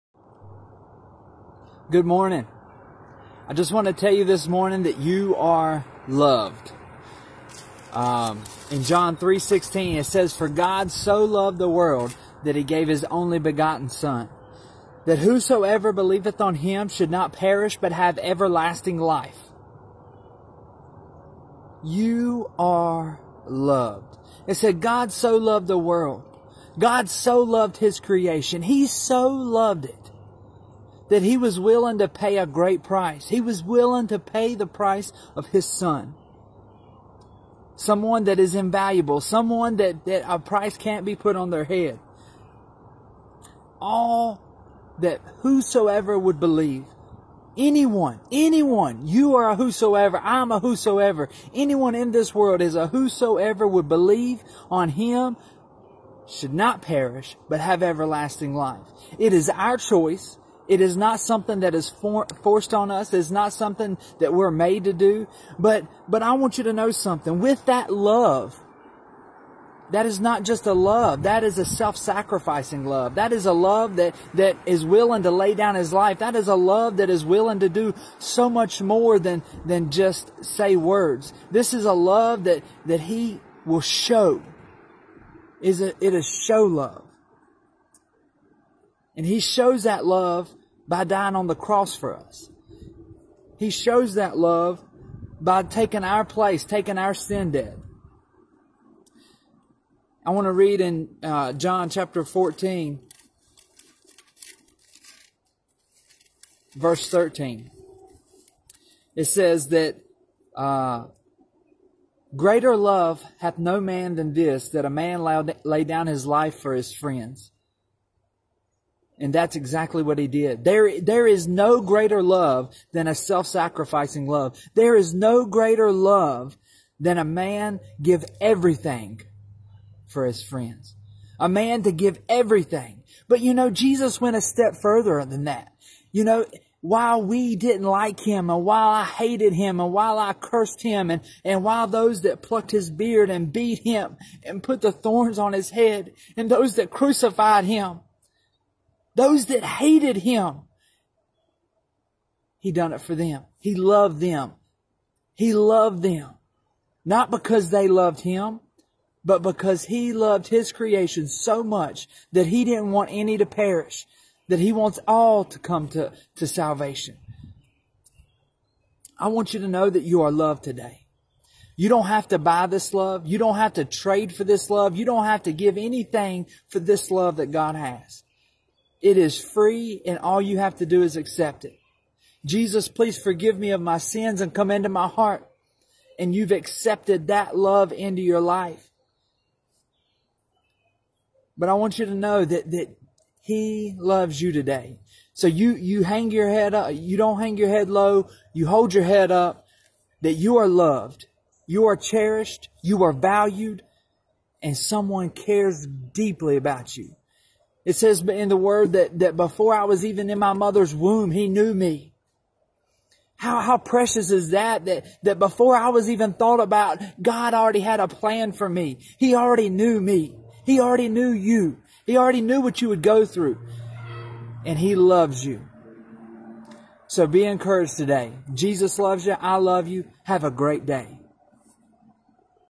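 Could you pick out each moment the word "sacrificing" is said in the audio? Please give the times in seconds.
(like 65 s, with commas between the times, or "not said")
71 s, 123 s.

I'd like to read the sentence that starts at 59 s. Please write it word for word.
It is our choice it is not something that is for, forced on us.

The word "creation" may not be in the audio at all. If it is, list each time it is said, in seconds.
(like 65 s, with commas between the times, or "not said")
27 s, 160 s.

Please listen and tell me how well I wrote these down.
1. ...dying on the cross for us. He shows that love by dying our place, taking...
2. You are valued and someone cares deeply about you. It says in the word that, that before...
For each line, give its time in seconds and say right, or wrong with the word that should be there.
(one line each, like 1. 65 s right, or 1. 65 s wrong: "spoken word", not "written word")
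1. 91 s wrong: "taking", not "dying"
2. 202 s right.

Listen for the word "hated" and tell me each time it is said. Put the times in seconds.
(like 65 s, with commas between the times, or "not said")
139 s, 149 s.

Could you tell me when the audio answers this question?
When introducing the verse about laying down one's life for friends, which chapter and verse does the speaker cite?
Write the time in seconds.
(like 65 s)
101 s.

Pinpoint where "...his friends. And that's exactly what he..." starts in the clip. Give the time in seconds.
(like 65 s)
116 s.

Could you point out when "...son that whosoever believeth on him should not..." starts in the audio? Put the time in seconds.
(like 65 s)
13 s.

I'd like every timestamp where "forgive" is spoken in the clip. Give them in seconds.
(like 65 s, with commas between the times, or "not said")
183 s.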